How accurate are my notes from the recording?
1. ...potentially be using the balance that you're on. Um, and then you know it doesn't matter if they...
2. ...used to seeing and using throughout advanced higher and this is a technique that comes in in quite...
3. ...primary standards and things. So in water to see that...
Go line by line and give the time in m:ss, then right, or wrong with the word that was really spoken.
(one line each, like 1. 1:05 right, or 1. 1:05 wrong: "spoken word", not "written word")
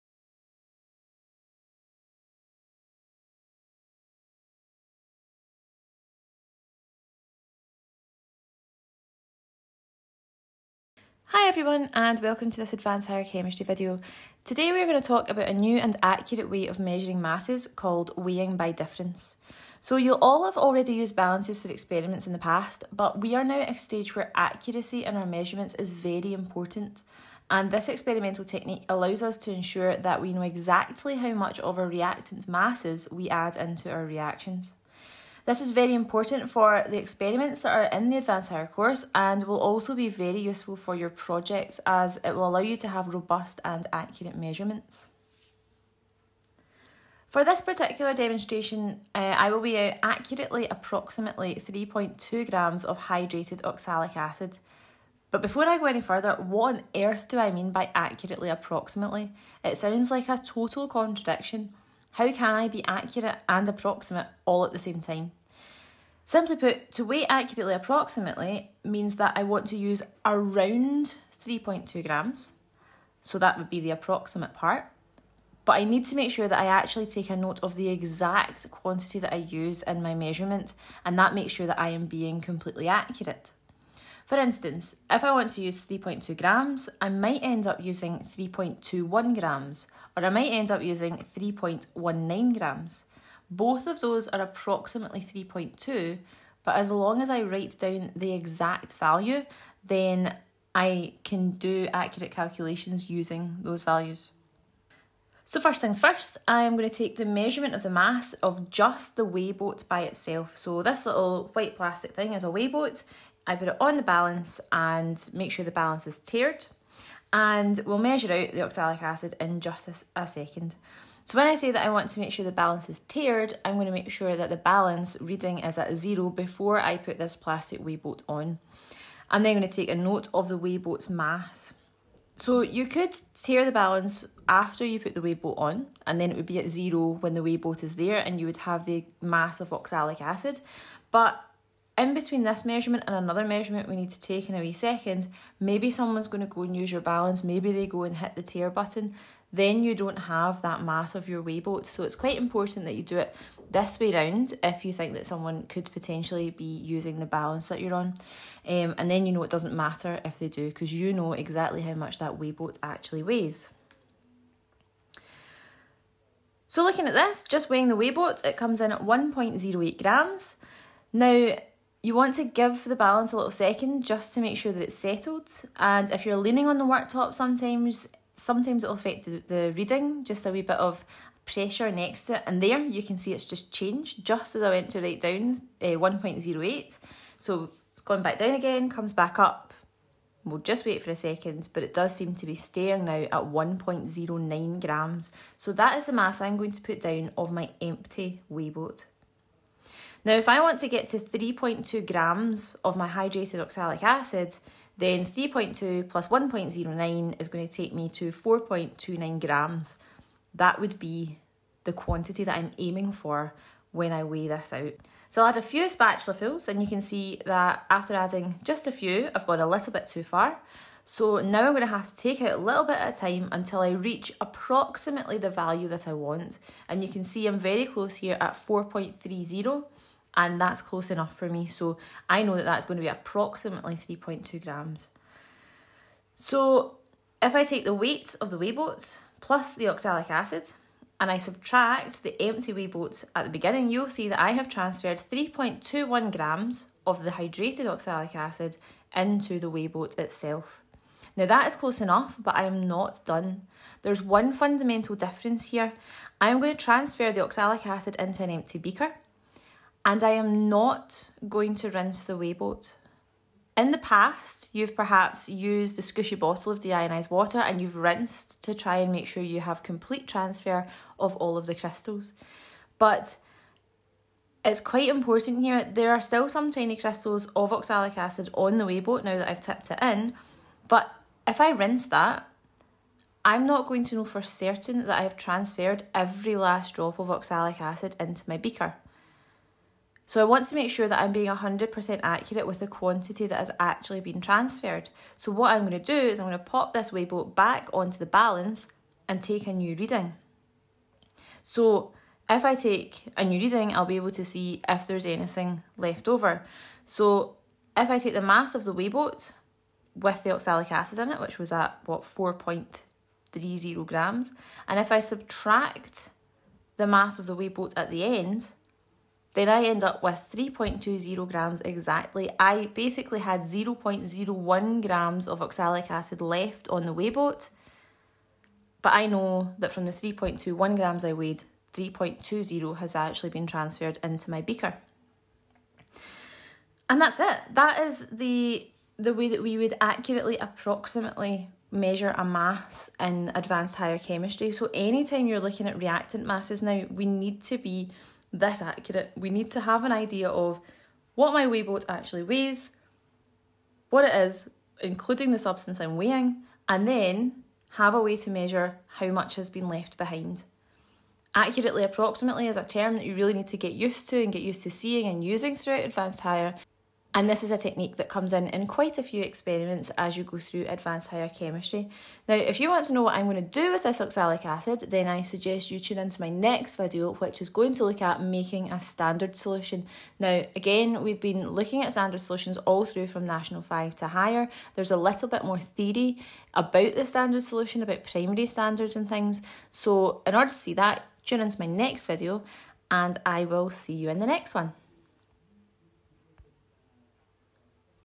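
1. 2:35 right
2. 6:04 right
3. 6:28 wrong: "order", not "water".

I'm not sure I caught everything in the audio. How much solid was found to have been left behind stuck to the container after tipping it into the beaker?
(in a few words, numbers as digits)
0.01 grams.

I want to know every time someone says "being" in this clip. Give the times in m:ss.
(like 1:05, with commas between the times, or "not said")
1:22, 4:51.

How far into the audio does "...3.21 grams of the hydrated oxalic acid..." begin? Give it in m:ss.
4:05.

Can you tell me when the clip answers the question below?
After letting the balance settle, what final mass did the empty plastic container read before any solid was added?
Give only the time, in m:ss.
3:13.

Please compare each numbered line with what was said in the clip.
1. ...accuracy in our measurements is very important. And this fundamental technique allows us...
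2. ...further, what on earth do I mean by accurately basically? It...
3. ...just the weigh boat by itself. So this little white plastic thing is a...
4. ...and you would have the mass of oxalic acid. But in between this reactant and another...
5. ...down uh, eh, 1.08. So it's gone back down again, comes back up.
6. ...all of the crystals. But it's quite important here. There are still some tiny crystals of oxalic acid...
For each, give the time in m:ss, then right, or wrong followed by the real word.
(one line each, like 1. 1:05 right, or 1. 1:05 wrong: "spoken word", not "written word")
1. 0:24 wrong: "experimental", not "fundamental"
2. 0:56 wrong: "approximately", not "basically"
3. 1:48 right
4. 2:18 wrong: "measurement", not "reactant"
5. 3:05 right
6. 4:31 right.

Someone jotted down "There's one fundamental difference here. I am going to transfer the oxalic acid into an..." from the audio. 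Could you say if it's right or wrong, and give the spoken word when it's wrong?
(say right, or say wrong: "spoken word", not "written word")
right.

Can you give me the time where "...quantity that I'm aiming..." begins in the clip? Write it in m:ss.
3:31.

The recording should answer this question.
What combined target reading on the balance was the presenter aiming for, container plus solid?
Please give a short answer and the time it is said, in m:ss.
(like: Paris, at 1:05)
4.29 grams, at 3:28.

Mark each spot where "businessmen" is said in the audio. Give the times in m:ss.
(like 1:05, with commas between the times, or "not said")
not said.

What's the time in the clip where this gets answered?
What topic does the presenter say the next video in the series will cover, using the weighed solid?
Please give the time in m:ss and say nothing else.
6:18.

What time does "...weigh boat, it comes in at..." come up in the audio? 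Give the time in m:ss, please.
2:47.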